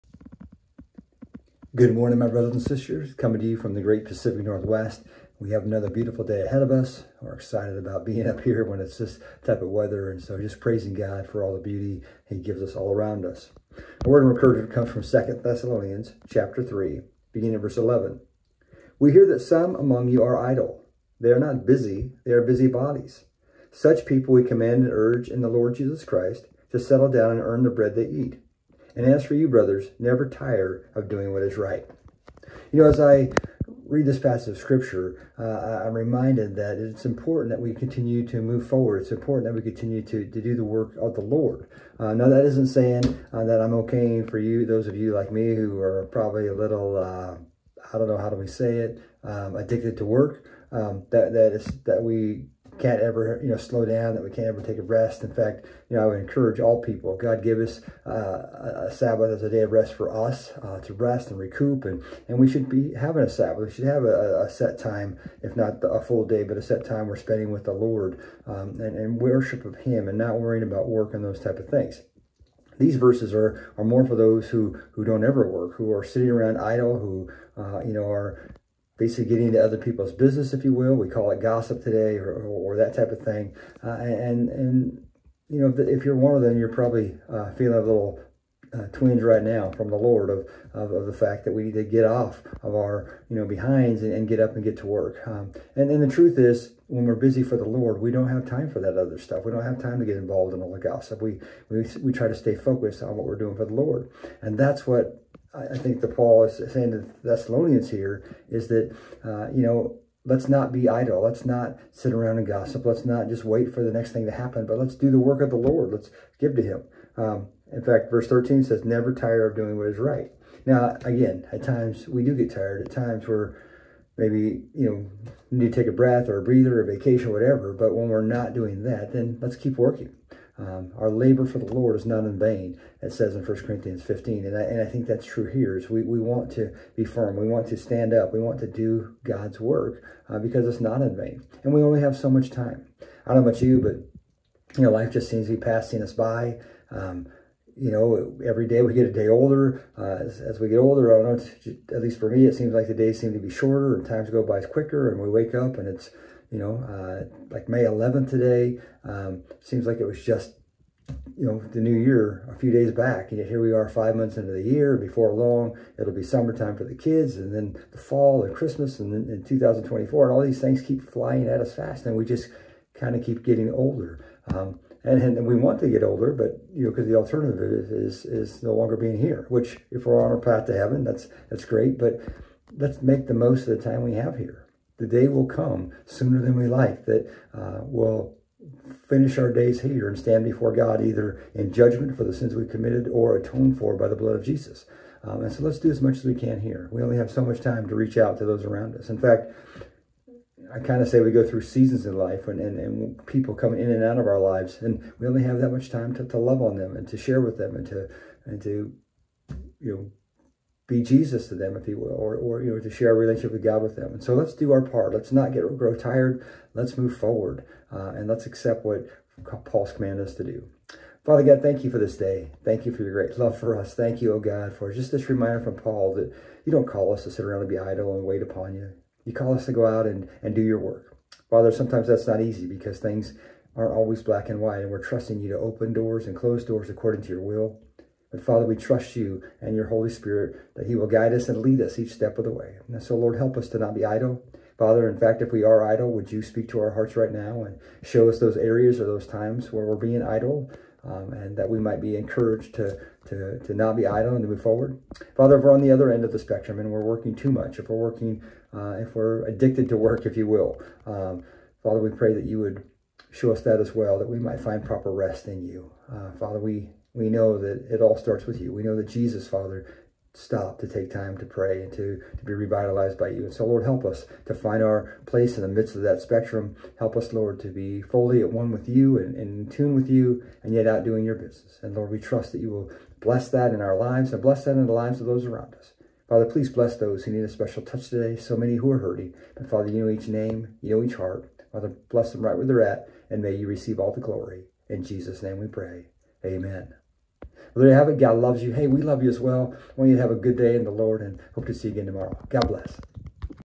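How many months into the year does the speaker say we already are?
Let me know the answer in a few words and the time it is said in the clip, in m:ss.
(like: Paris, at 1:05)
5, at 2:43.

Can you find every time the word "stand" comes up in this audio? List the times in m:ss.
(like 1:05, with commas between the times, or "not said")
2:17, 3:10.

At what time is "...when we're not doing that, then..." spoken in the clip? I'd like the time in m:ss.
2:07.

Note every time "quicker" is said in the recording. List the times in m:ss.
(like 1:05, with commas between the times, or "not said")
2:34.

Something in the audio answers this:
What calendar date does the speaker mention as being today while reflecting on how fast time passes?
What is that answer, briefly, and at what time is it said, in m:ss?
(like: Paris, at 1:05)
May 11, at 2:37.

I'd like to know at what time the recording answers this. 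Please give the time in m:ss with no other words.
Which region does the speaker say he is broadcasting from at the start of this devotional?
0:04.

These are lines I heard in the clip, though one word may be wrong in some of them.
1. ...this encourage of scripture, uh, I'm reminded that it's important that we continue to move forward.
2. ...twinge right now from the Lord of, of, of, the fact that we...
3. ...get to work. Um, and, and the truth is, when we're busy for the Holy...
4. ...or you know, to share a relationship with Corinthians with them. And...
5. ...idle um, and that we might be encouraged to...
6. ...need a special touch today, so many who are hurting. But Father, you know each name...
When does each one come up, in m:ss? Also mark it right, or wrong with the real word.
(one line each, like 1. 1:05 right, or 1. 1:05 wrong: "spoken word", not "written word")
1. 0:34 wrong: "passage", not "encourage"
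2. 1:28 right
3. 1:34 wrong: "Lord", not "Holy"
4. 3:32 wrong: "God", not "Corinthians"
5. 4:10 right
6. 4:47 right.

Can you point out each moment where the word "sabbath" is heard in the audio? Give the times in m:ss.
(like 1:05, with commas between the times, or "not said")
0:58, 1:03.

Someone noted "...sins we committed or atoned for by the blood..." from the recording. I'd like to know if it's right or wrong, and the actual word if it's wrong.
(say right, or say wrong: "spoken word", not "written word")
right.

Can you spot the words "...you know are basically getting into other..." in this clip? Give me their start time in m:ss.
1:17.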